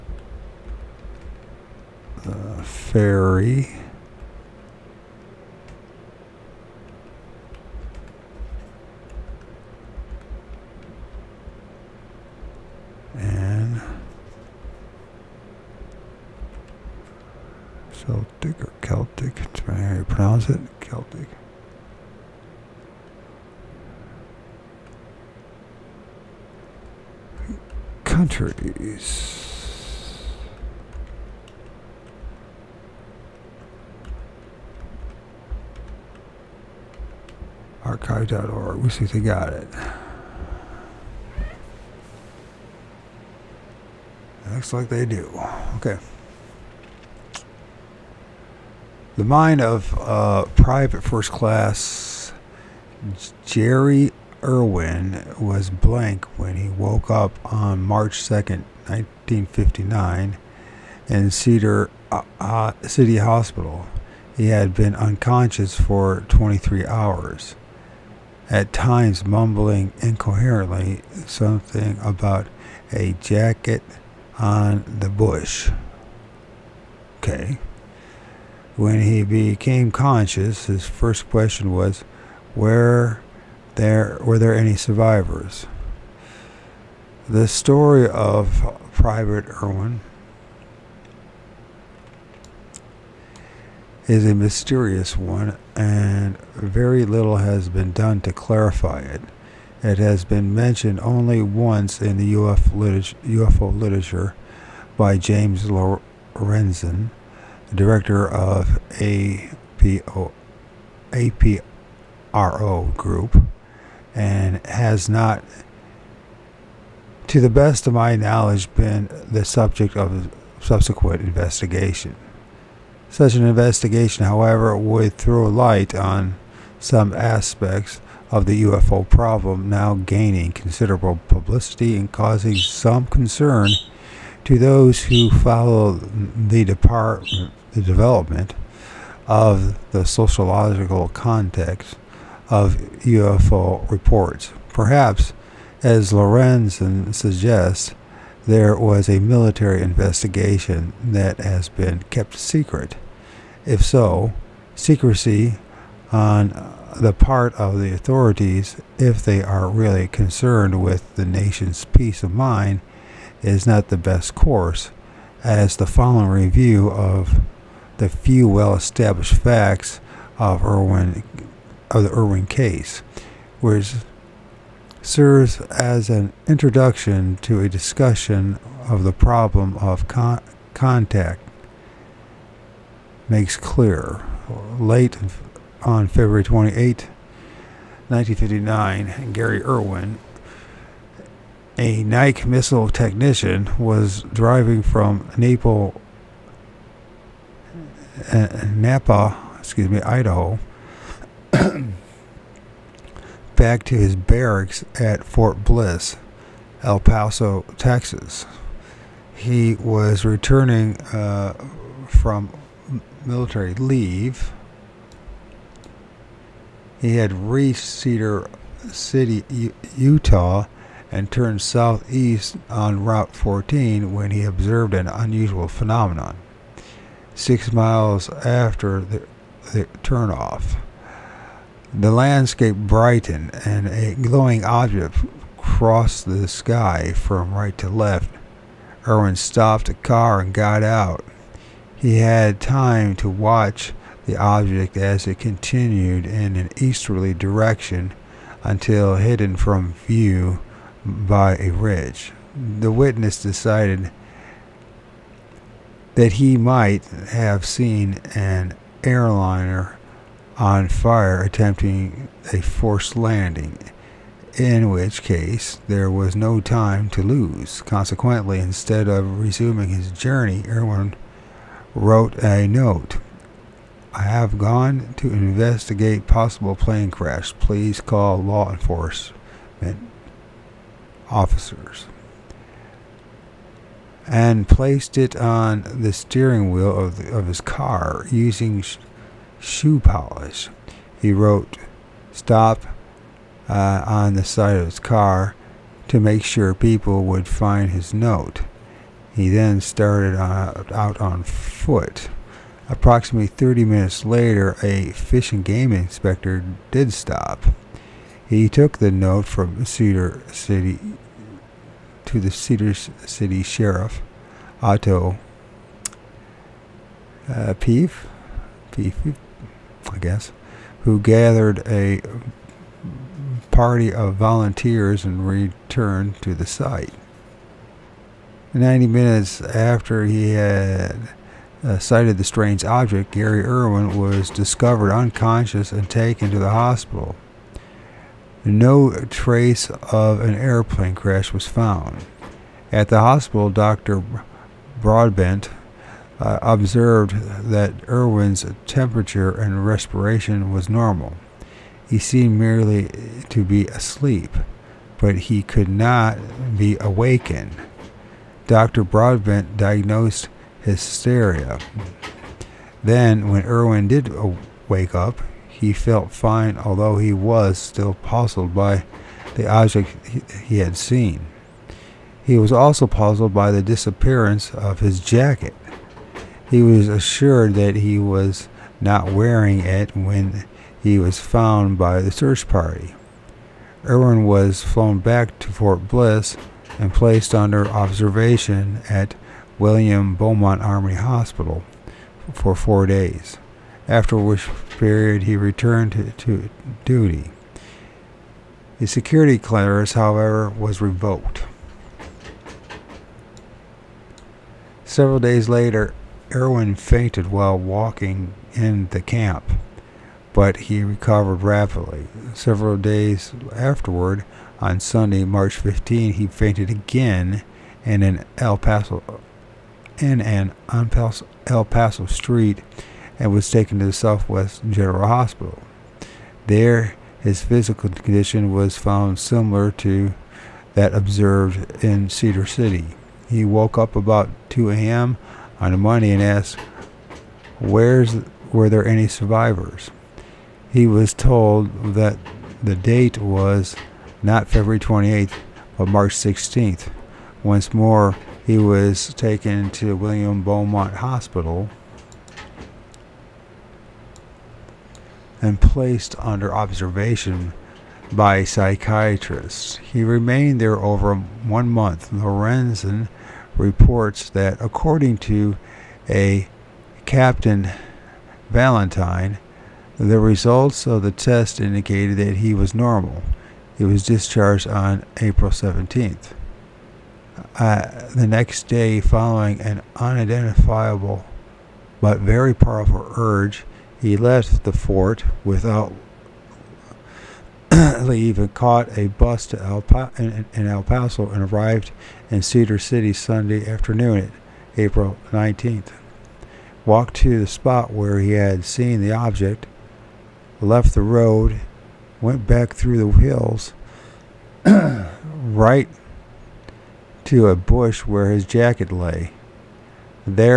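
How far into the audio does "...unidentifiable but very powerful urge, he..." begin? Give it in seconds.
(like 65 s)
480 s.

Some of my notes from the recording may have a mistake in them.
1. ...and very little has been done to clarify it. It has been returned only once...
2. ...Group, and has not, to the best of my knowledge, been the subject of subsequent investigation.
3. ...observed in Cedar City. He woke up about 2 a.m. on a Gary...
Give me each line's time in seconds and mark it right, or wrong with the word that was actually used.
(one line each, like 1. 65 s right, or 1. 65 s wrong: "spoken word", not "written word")
1. 95 s wrong: "mentioned", not "returned"
2. 112 s right
3. 431 s wrong: "Monday", not "Gary".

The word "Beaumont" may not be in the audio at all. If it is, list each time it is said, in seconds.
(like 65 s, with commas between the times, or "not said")
390 s, 450 s.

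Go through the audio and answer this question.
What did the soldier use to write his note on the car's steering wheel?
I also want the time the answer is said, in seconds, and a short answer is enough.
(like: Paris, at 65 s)
shoe polish, at 289 s.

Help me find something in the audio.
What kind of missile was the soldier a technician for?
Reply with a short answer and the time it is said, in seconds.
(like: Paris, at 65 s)
Nike, at 192 s.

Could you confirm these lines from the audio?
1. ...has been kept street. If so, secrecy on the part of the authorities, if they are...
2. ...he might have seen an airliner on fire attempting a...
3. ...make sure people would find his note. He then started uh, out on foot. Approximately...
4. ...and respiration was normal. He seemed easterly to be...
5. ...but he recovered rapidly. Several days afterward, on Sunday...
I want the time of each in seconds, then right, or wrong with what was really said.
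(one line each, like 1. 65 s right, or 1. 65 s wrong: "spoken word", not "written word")
1. 151 s wrong: "secret", not "street"
2. 256 s right
3. 296 s right
4. 349 s wrong: "merely", not "easterly"
5. 410 s right.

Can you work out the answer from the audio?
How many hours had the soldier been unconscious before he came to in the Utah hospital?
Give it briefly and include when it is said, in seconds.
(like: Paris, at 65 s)
23, at 66 s.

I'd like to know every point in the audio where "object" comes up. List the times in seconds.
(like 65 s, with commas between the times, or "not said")
234 s, 244 s, 332 s, 369 s, 499 s.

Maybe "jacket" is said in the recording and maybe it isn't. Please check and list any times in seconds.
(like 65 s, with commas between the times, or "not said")
73 s, 375 s, 508 s.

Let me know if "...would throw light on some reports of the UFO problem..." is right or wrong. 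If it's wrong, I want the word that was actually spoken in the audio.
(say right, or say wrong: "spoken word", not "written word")
wrong: "aspects", not "reports".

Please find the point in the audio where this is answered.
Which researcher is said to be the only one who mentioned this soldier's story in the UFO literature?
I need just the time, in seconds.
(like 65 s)
105 s.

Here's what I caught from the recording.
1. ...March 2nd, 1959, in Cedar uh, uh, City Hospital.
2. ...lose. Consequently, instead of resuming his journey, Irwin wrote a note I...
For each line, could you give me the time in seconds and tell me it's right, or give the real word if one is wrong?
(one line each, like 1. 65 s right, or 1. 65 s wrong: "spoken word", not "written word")
1. 57 s right
2. 267 s right.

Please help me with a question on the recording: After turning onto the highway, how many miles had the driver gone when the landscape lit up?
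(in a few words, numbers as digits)
6.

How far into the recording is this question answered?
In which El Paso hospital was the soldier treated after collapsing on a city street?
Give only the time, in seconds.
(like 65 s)
424 s.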